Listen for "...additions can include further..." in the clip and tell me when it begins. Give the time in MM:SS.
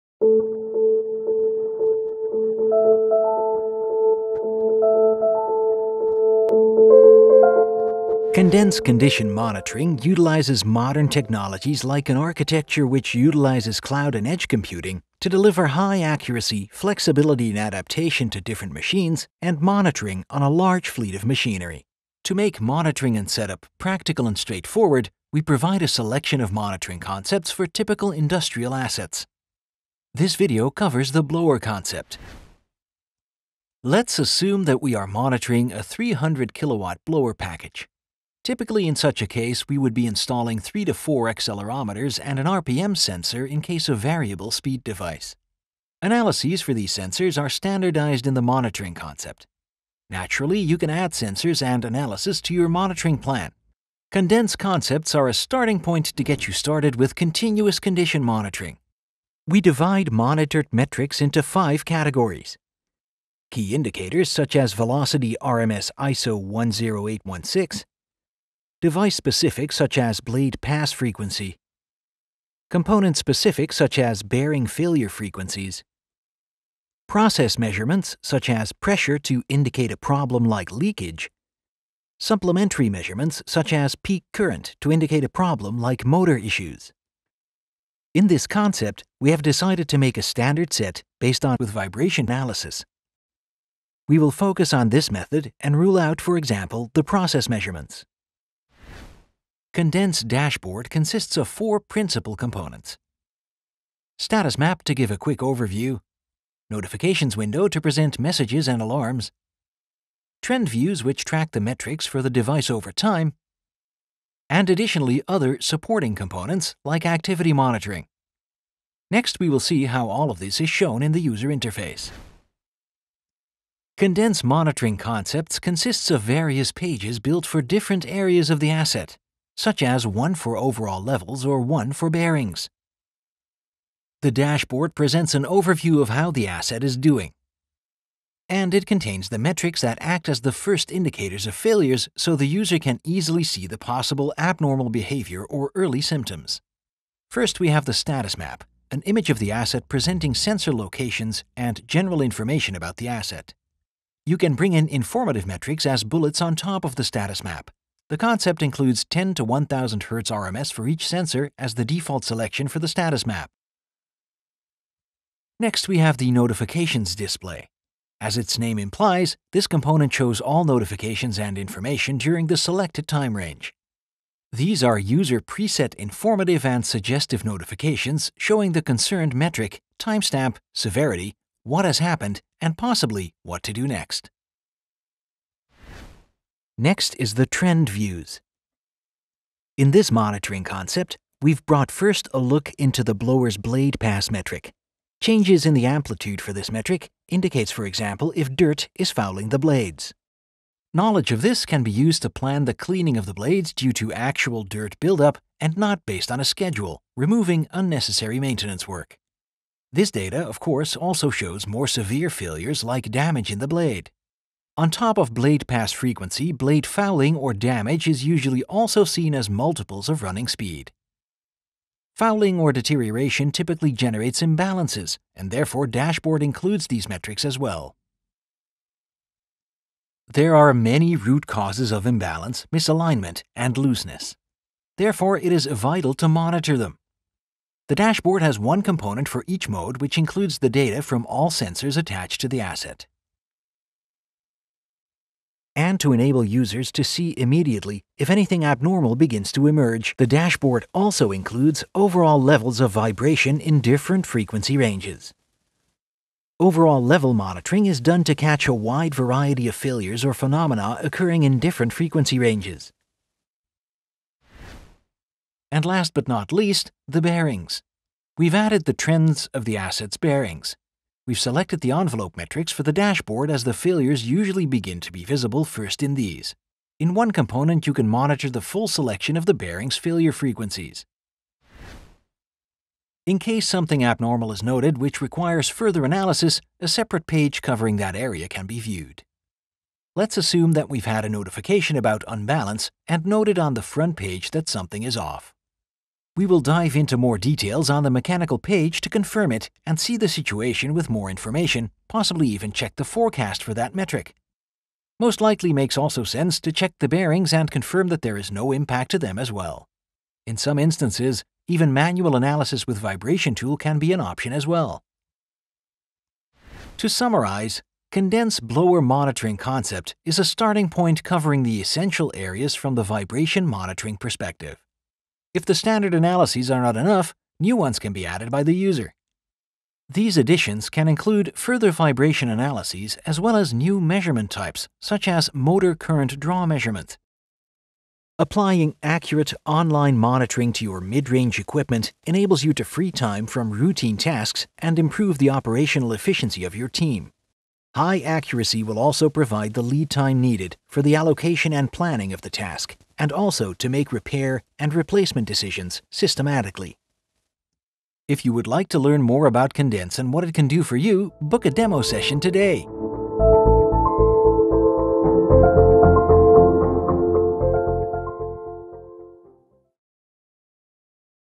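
05:30.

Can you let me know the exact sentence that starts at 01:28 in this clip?
In this concept, we have decided to make a standard set based on with vibration analysis.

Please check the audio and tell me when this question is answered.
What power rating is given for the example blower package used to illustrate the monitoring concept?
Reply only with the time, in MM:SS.
00:35.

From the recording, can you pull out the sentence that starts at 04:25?
And last but not least, the bearings.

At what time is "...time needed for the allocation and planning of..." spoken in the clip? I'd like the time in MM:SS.
05:50.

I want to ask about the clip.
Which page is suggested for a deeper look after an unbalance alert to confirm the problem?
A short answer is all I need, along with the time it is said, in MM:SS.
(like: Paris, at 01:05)
mechanical page, at 04:58.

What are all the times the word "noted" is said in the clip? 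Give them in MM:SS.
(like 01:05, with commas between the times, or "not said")
04:44, 04:53.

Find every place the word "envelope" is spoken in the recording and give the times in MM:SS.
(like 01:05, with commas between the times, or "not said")
04:31.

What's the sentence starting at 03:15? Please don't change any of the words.
Changes in the amplitude for this metric indicates, for example, if dirt is fouling the blades.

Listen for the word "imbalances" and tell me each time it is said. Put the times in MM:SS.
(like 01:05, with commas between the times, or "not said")
03:44, 03:52.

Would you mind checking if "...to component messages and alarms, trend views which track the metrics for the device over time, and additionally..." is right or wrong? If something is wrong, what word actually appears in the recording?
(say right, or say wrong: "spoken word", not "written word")
wrong: "present", not "component".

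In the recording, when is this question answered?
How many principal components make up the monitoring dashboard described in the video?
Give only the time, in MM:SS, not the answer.
01:41.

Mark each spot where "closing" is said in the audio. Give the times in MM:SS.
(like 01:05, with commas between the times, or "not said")
not said.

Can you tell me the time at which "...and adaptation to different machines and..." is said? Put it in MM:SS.
00:17.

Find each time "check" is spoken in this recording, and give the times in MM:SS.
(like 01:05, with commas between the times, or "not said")
05:02, 05:06.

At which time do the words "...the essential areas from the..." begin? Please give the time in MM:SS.
05:21.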